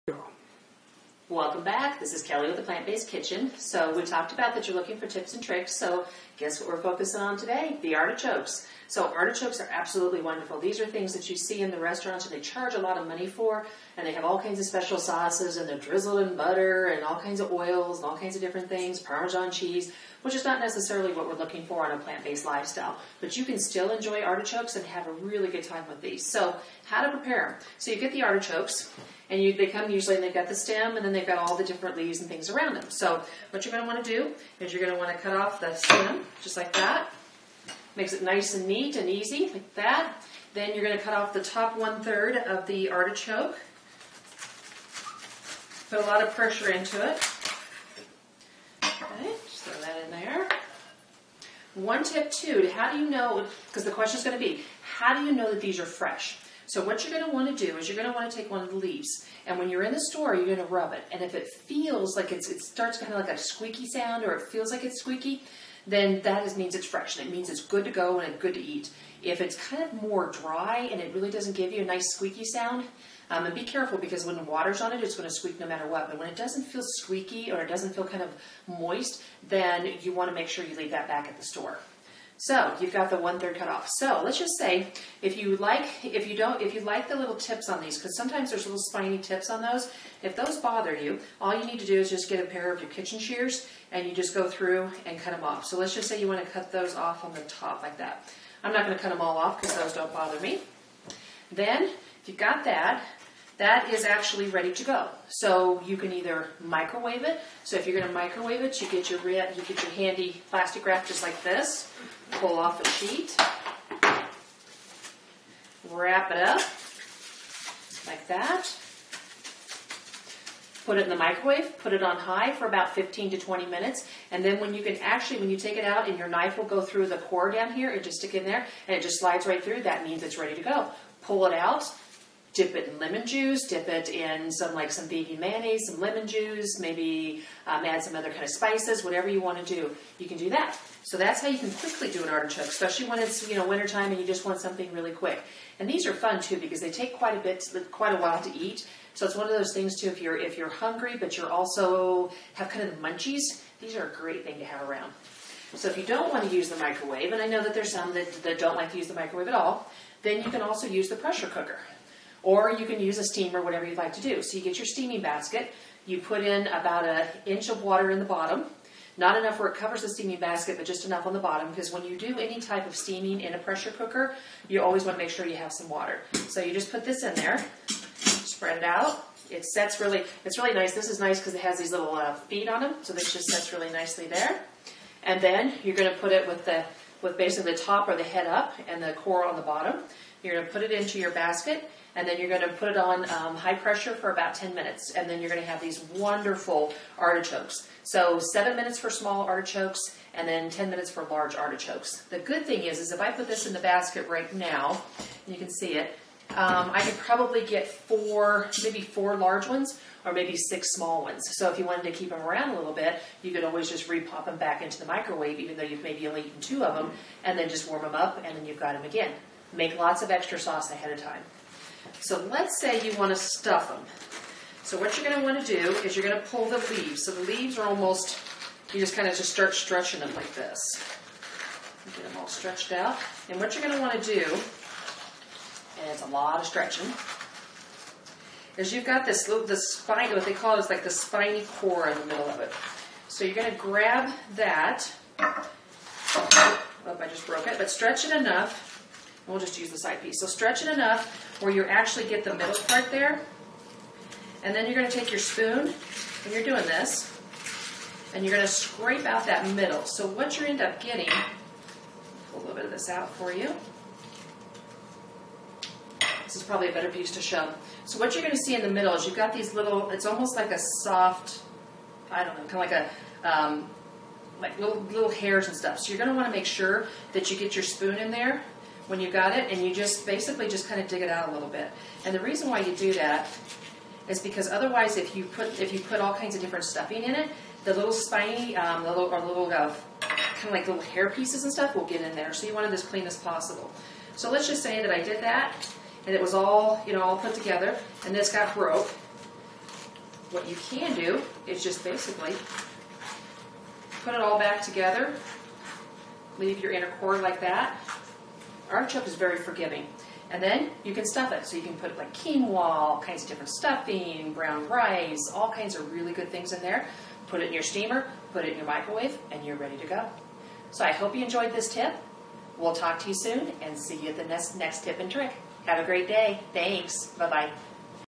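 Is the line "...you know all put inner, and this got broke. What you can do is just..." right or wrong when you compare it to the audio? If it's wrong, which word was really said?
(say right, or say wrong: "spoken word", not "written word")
wrong: "together", not "inner".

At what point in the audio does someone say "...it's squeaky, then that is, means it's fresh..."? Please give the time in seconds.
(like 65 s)
64 s.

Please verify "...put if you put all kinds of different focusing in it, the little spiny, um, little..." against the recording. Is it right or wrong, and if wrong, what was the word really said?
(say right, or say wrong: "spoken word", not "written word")
wrong: "stuffing", not "focusing".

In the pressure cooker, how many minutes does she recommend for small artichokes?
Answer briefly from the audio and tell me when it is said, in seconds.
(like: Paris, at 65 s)
7, at 198 s.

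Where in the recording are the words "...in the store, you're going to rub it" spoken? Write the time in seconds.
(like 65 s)
59 s.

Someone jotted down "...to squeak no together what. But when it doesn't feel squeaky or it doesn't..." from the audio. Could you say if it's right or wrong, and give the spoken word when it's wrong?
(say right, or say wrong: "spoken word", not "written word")
wrong: "matter", not "together".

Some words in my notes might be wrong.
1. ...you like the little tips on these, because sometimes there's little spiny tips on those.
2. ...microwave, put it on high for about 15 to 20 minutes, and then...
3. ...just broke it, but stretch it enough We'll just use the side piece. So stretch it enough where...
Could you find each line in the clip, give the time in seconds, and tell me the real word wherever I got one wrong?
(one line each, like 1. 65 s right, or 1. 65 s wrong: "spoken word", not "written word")
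1. 86 s right
2. 121 s right
3. 247 s right.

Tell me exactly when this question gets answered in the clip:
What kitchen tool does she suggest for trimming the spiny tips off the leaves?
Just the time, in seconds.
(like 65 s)
92 s.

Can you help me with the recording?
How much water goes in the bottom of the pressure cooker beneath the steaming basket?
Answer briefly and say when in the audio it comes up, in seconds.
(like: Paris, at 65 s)
about an inch, at 166 s.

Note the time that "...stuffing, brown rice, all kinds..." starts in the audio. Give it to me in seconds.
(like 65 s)
313 s.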